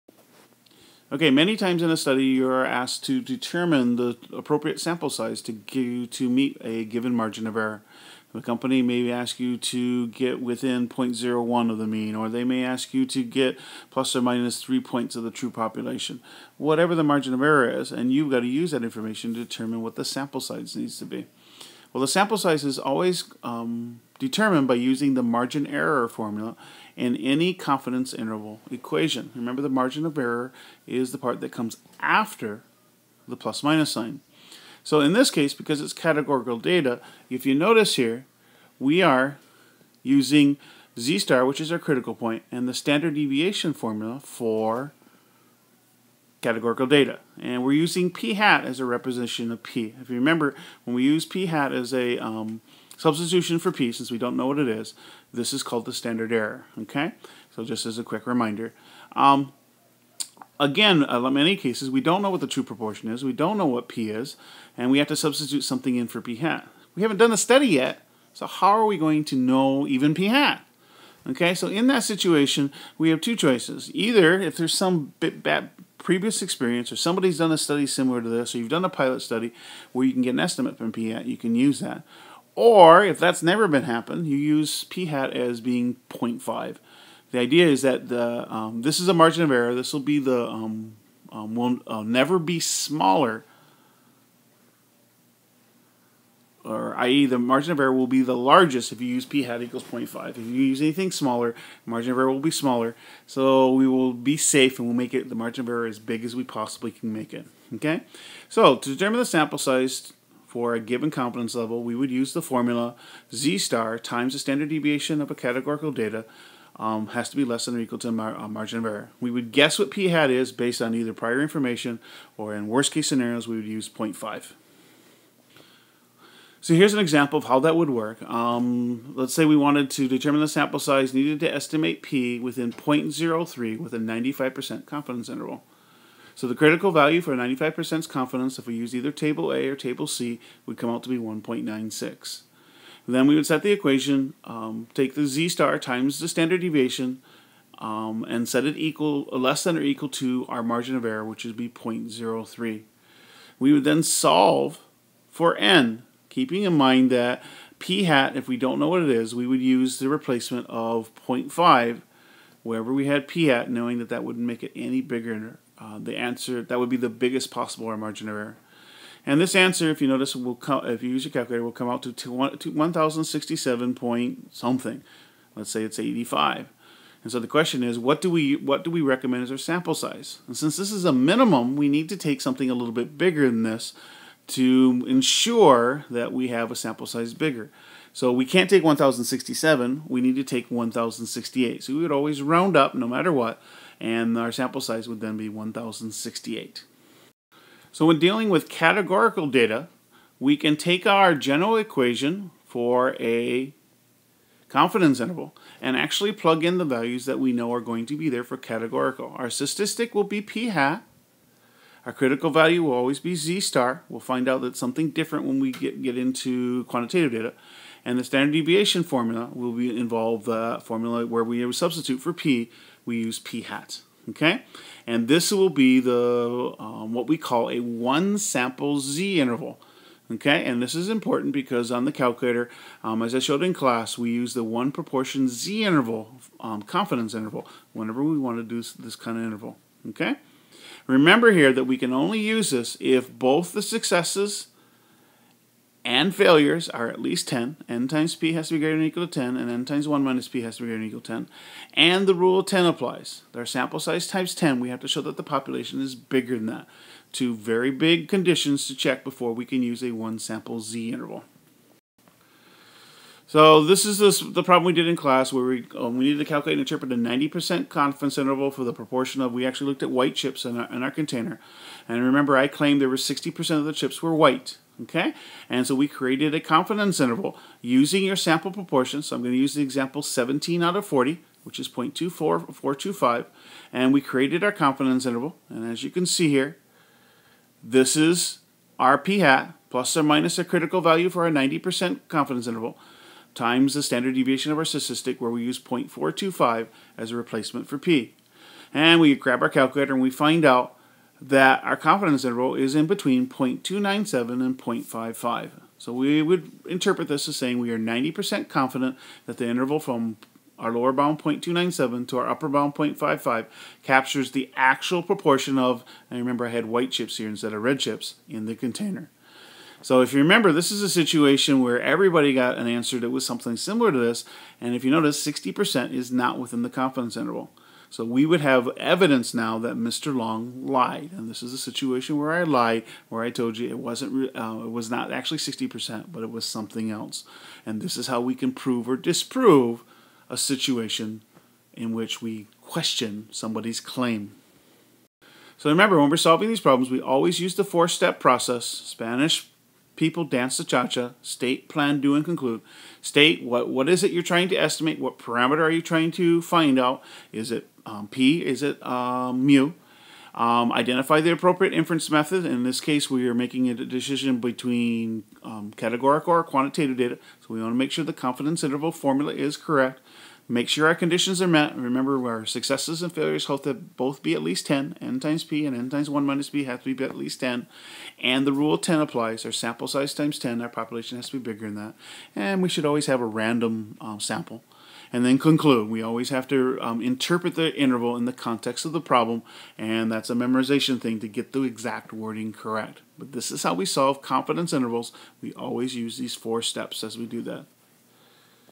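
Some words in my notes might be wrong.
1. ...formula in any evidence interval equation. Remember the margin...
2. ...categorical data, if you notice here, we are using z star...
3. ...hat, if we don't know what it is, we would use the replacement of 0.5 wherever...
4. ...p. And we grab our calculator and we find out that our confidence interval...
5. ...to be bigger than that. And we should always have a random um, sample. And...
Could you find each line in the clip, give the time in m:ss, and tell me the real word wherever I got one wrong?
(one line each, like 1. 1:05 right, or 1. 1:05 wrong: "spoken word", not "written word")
1. 0:26 wrong: "confidence", not "evidence"
2. 0:35 right
3. 2:38 right
4. 4:57 right
5. 6:21 right.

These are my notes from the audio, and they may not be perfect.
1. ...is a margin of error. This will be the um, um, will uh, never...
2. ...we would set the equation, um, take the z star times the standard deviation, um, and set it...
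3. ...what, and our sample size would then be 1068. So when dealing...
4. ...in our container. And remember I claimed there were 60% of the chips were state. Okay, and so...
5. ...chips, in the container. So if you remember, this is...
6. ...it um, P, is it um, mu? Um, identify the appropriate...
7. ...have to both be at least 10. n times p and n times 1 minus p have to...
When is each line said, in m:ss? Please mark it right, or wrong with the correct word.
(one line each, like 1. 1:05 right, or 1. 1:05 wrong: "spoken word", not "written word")
1. 1:28 right
2. 2:23 right
3. 3:13 right
4. 4:30 wrong: "white", not "state"
5. 5:17 right
6. 5:57 right
7. 6:13 right.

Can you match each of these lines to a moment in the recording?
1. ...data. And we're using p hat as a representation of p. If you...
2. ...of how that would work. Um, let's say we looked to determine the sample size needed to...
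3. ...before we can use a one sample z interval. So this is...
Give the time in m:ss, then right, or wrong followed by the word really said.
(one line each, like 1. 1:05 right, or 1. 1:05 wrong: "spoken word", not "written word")
1. 0:46 right
2. 2:07 wrong: "wanted", not "looked"
3. 4:19 right.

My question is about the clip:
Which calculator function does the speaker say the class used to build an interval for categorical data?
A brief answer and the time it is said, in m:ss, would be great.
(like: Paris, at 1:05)
one proportion z interval, at 3:54.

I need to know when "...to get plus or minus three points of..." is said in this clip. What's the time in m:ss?
0:13.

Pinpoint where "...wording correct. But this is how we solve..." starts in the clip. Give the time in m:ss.
6:32.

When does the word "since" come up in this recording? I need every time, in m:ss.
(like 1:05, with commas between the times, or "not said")
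0:53, 3:00.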